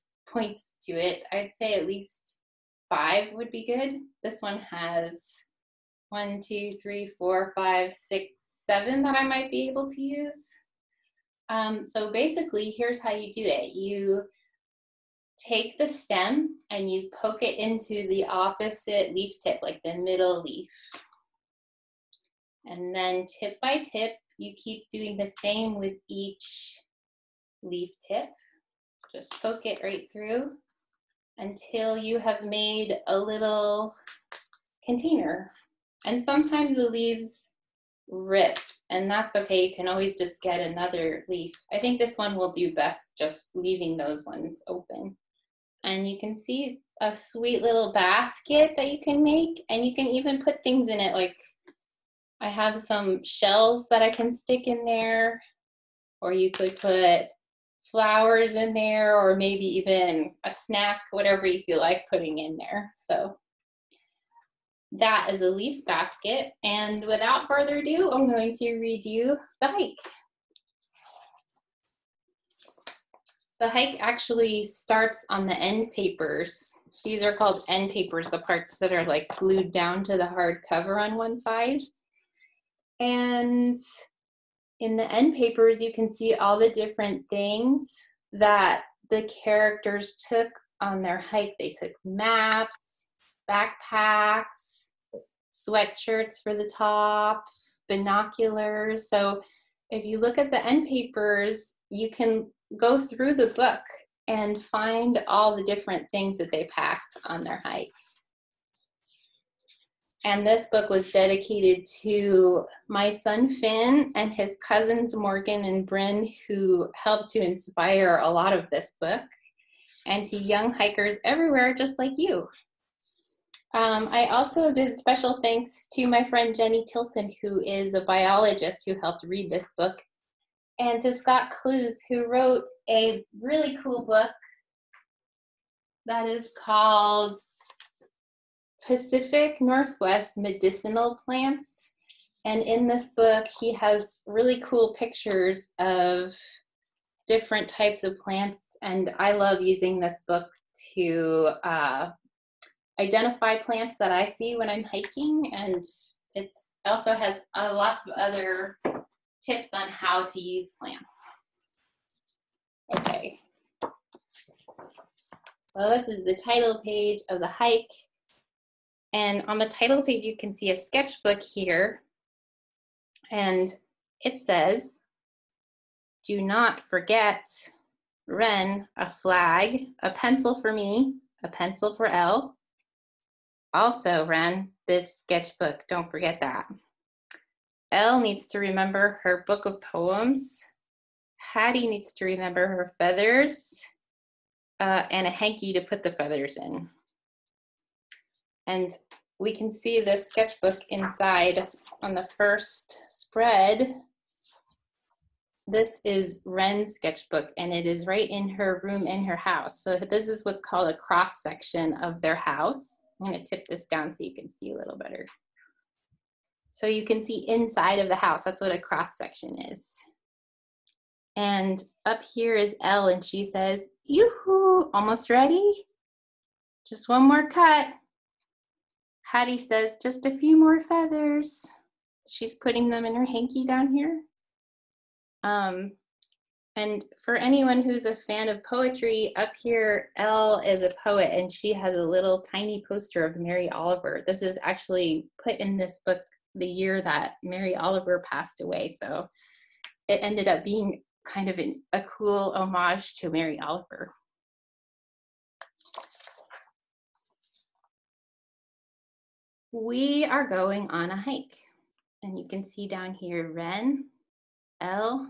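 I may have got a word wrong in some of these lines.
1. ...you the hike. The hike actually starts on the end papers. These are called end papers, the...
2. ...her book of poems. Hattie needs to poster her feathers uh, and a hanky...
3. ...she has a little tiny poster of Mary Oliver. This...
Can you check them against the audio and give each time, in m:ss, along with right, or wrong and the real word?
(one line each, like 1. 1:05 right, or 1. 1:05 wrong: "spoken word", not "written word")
1. 1:09 right
2. 3:09 wrong: "remember", not "poster"
3. 4:01 right.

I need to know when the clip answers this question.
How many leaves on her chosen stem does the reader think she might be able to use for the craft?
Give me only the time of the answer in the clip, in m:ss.
0:08.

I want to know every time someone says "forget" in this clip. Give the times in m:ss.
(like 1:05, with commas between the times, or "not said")
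2:56, 3:06.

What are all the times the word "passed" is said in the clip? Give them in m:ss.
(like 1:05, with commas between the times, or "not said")
4:08.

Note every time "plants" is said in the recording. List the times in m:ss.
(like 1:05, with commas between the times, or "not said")
2:21, 2:28, 2:33, 2:40.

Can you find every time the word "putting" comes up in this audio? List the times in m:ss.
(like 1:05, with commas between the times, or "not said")
1:02, 3:52.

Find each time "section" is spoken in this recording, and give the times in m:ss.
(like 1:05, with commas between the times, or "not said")
3:31, 3:39.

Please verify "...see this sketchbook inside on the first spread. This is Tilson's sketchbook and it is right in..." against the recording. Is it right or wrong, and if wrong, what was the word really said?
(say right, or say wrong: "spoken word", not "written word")
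wrong: "Ren", not "Tilson".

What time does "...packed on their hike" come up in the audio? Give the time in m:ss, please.
1:46.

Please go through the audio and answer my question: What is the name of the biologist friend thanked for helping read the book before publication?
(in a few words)
Jenny Tilson.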